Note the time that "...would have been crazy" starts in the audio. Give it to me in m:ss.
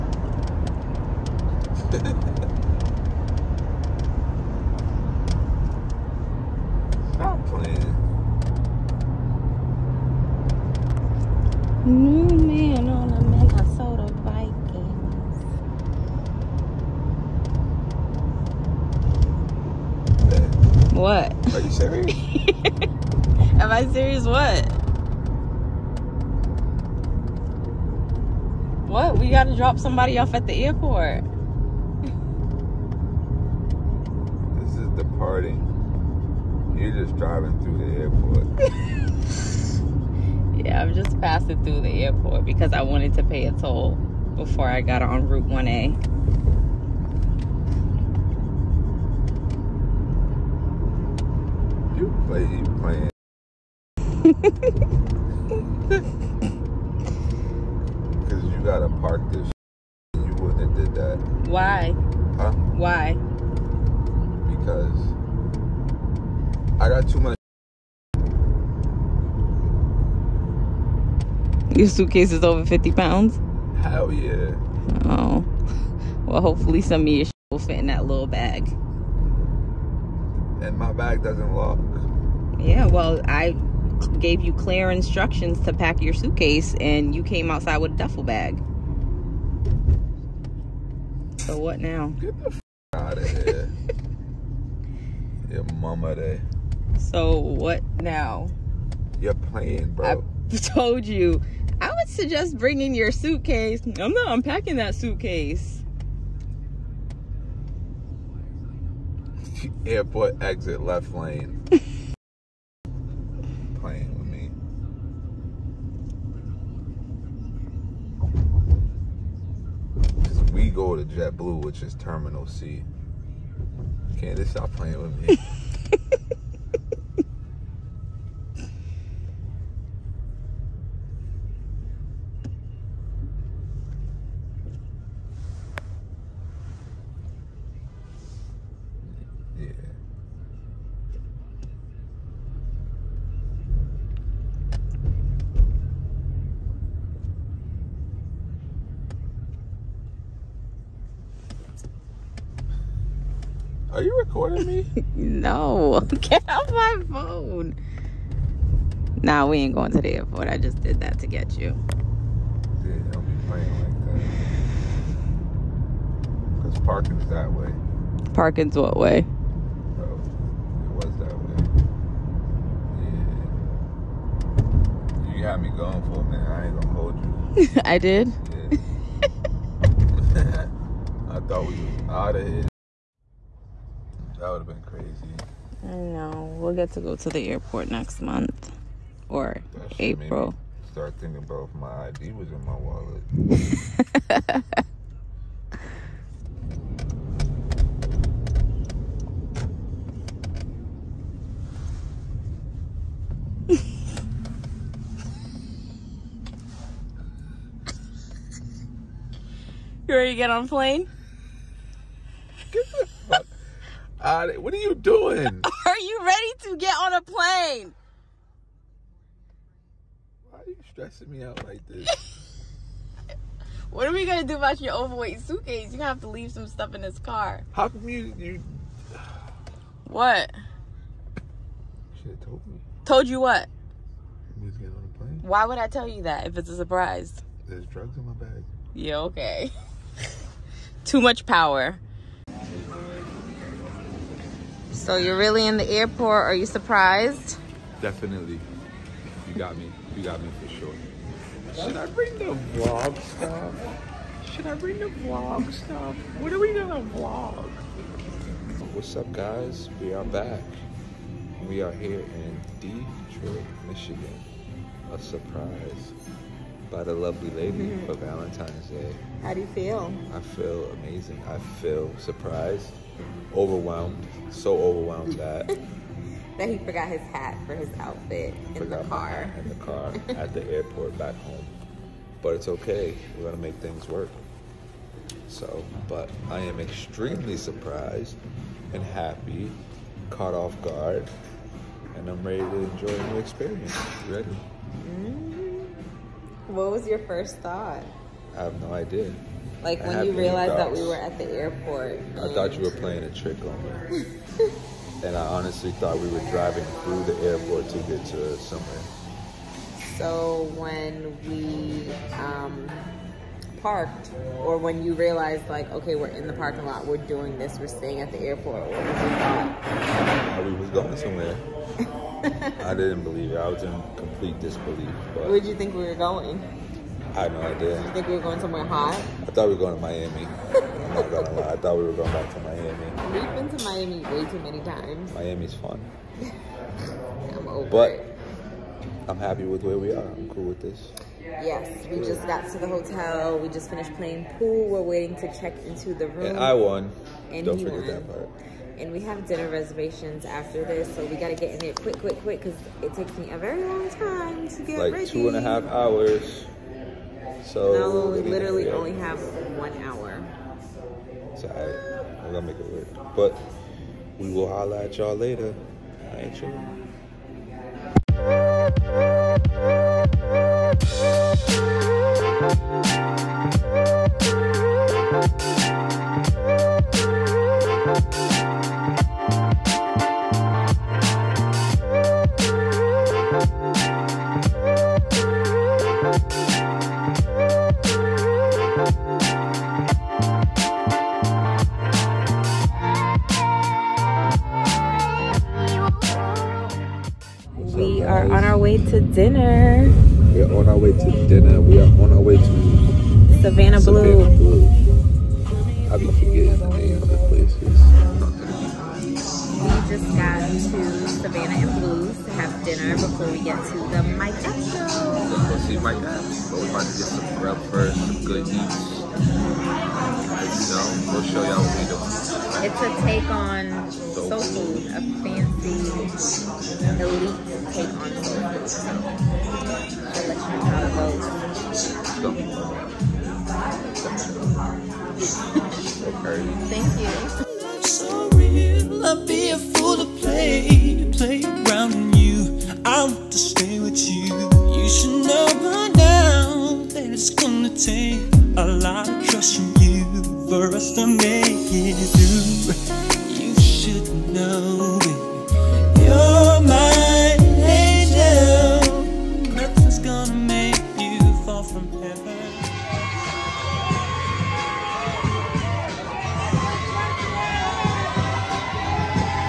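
3:04.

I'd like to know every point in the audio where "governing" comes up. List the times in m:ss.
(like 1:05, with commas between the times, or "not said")
not said.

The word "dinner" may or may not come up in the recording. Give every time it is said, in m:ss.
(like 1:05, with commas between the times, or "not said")
5:49, 6:41.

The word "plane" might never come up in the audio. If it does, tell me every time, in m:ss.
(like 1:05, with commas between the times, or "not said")
3:30, 3:37, 3:55.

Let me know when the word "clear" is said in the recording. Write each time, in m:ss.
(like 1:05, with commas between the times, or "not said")
1:24.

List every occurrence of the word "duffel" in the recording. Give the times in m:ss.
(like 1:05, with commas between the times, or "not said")
1:27.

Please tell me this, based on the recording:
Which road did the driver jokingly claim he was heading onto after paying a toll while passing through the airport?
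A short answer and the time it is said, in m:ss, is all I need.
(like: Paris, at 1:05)
Route 1A, at 0:45.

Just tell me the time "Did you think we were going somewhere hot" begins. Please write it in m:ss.
5:27.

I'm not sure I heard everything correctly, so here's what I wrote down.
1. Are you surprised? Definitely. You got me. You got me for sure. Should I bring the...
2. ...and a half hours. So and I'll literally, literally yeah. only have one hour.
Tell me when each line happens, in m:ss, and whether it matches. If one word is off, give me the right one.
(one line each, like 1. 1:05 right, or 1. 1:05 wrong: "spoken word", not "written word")
1. 4:06 right
2. 5:55 right.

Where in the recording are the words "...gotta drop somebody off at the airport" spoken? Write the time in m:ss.
0:29.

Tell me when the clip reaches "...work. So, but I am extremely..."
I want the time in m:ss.
4:44.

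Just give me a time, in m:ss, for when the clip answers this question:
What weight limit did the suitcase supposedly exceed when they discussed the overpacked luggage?
1:12.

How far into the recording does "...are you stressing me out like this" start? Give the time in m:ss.
3:40.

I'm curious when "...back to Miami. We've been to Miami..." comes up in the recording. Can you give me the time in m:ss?
5:32.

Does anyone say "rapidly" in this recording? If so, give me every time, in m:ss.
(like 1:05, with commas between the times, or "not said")
not said.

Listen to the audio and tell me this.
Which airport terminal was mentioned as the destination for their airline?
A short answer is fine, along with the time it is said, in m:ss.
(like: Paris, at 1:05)
Terminal C, at 2:01.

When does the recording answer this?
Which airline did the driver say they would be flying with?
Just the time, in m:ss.
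2:01.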